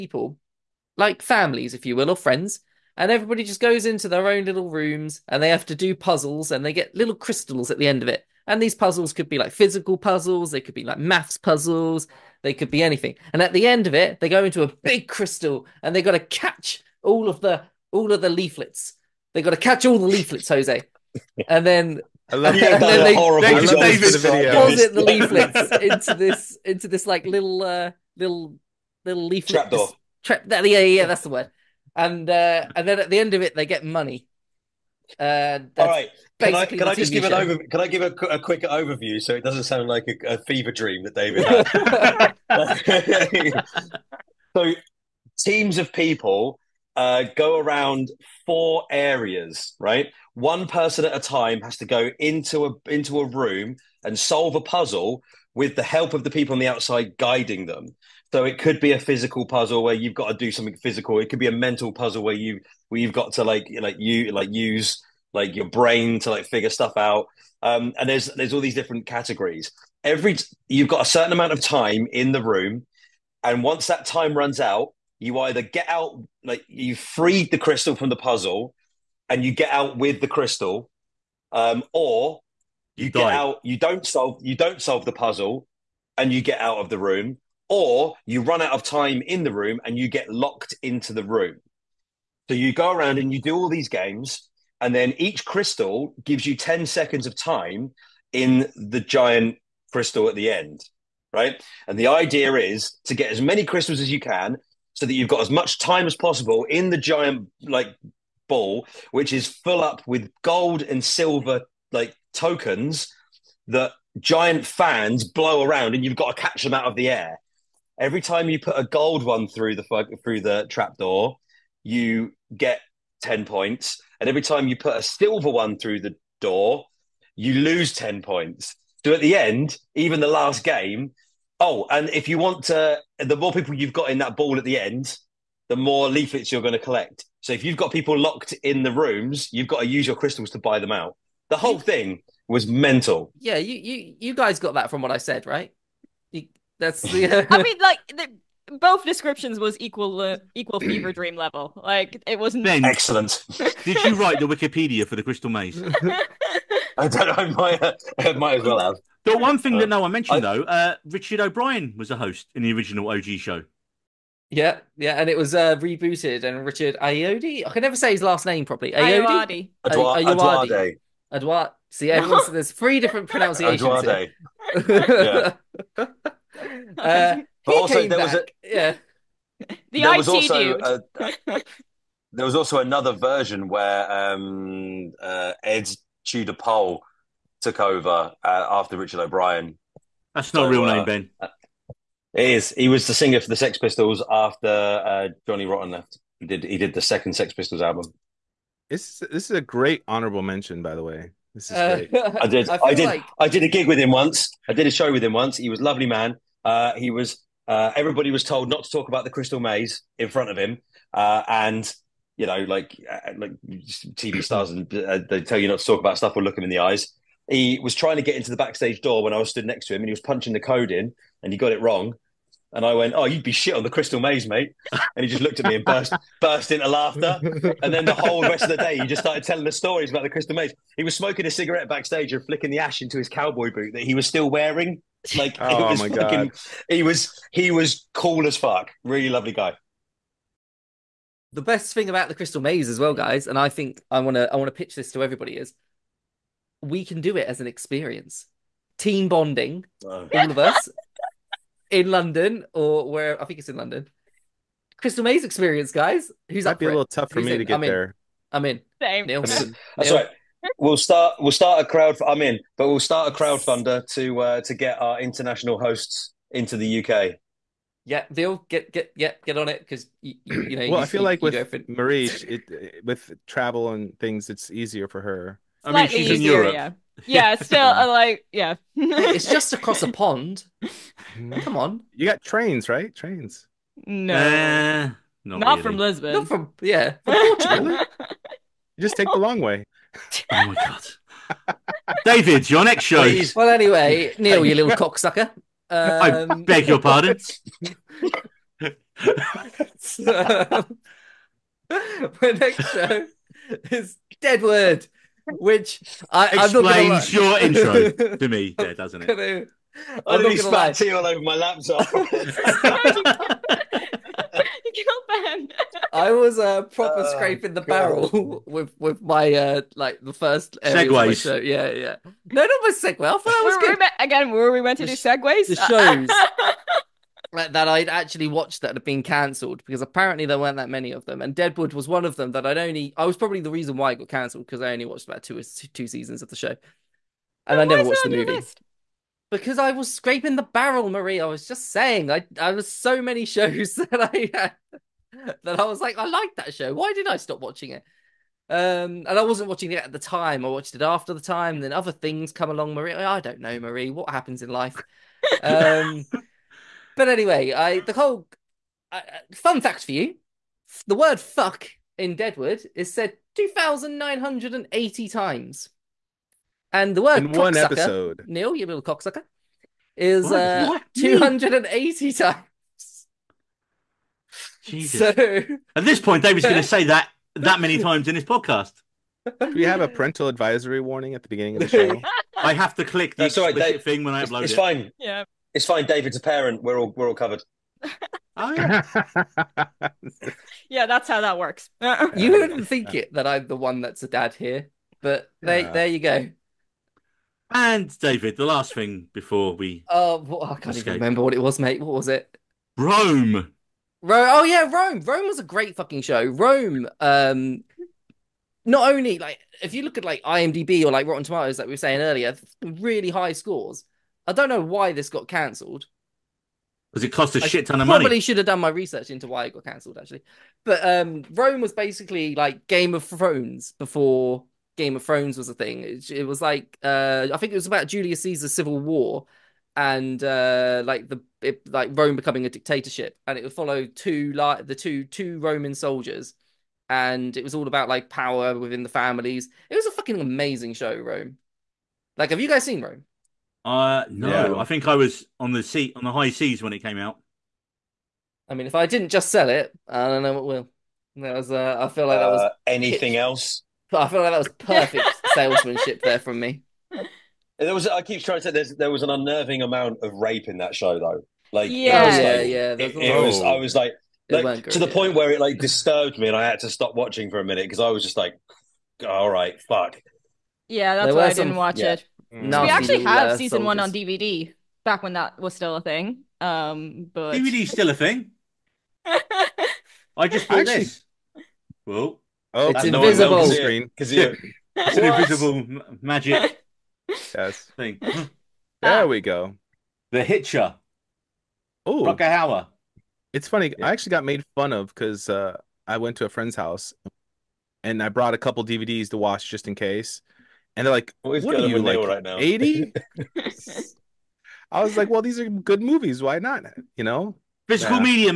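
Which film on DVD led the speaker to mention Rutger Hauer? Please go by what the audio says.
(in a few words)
The Hitcher.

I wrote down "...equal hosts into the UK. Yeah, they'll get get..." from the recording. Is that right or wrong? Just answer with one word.
wrong.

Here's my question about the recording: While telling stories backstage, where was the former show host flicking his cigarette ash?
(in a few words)
His cowboy boot.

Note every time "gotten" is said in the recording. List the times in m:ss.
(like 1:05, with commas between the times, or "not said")
not said.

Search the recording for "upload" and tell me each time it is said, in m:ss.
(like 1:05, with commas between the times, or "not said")
6:24.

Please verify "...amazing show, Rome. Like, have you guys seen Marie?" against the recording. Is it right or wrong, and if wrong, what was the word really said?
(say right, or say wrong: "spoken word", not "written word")
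wrong: "Rome", not "Marie".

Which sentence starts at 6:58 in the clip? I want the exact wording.
Probably should have done my research into why it got cancelled actually.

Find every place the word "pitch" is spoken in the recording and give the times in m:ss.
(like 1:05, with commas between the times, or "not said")
4:04, 7:33.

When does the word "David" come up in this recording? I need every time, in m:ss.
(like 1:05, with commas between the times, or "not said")
0:41, 4:52, 6:16, 6:26, 6:38.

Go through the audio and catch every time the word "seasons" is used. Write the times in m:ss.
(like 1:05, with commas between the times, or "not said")
5:36, 7:53.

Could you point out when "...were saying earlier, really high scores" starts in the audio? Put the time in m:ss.
6:51.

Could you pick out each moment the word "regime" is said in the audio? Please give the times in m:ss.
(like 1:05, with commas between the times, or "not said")
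not said.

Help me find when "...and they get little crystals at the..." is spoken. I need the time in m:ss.
0:06.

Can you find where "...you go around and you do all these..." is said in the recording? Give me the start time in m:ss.
1:32.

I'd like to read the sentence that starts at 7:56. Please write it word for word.
Um, but DVD's still a thing.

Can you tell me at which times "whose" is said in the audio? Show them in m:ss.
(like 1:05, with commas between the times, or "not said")
not said.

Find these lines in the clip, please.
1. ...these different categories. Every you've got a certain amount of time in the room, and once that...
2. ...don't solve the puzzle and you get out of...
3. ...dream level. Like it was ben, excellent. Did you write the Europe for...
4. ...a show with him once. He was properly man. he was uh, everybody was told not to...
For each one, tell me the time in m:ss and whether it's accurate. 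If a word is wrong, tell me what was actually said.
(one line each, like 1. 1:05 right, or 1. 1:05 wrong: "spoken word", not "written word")
1. 1:08 right
2. 1:24 right
3. 2:31 wrong: "Wikipedia", not "Europe"
4. 3:24 wrong: "lovely", not "properly".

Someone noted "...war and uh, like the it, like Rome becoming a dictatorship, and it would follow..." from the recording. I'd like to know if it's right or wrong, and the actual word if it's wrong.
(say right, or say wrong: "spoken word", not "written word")
right.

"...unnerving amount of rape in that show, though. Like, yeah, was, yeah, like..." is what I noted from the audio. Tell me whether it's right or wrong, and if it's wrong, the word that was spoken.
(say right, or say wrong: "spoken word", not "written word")
right.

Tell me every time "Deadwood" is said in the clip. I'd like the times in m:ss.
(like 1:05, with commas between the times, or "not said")
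5:04, 5:31, 6:02.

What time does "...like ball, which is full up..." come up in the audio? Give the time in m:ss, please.
1:47.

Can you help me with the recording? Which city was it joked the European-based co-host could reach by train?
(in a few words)
Lisbon.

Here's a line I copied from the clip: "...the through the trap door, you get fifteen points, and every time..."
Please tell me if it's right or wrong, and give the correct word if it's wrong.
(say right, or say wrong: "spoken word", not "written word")
wrong: "ten", not "fifteen".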